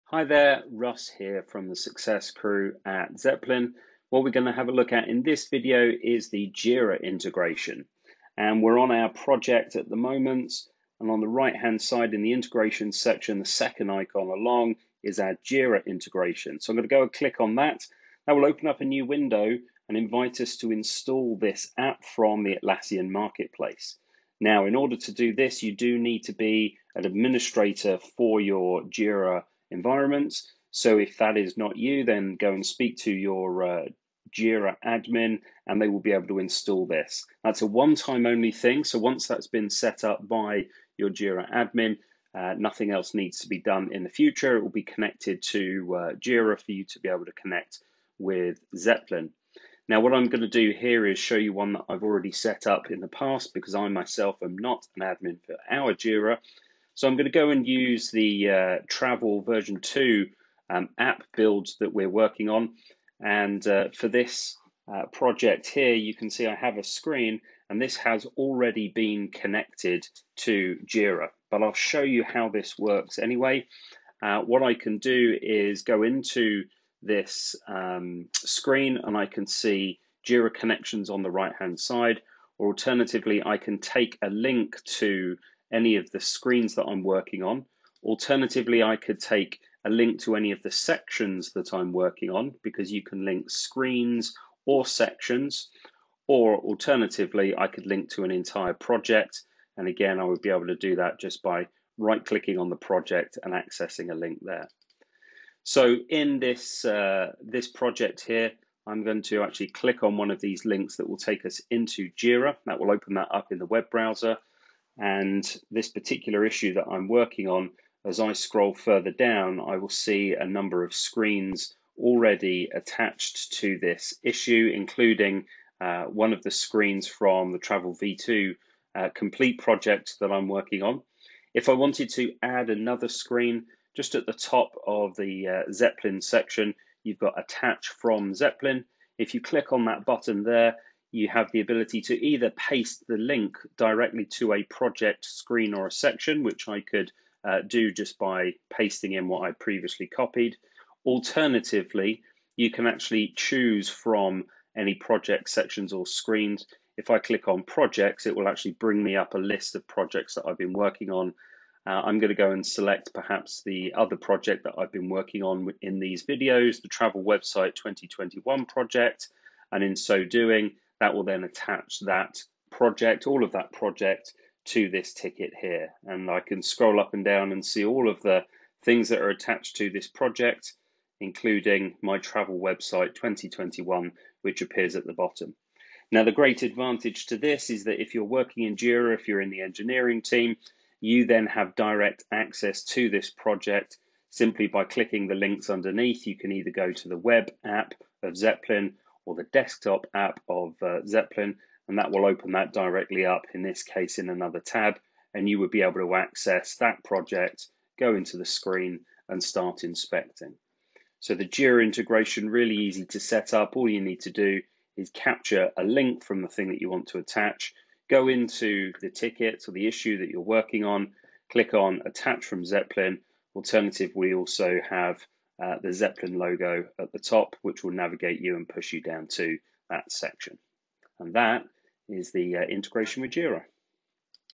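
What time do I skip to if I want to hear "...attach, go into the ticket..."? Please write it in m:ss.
3:37.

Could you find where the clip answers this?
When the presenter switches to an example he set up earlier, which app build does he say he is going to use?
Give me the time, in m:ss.
0:58.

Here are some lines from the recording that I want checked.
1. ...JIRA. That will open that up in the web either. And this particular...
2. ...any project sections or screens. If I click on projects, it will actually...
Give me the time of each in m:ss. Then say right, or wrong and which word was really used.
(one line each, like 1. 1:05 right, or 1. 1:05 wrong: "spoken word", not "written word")
1. 1:52 wrong: "browser", not "either"
2. 2:34 right.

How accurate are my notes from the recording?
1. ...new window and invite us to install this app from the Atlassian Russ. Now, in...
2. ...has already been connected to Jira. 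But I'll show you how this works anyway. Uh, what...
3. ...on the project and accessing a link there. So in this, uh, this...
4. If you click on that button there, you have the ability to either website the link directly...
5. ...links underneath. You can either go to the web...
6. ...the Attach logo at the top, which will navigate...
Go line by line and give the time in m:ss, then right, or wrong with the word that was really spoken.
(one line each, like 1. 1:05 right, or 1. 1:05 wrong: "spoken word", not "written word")
1. 0:18 wrong: "Marketplace", not "Russ"
2. 1:07 right
3. 1:42 right
4. 2:19 wrong: "paste", not "website"
5. 3:15 right
6. 3:45 wrong: "Zeplin", not "Attach".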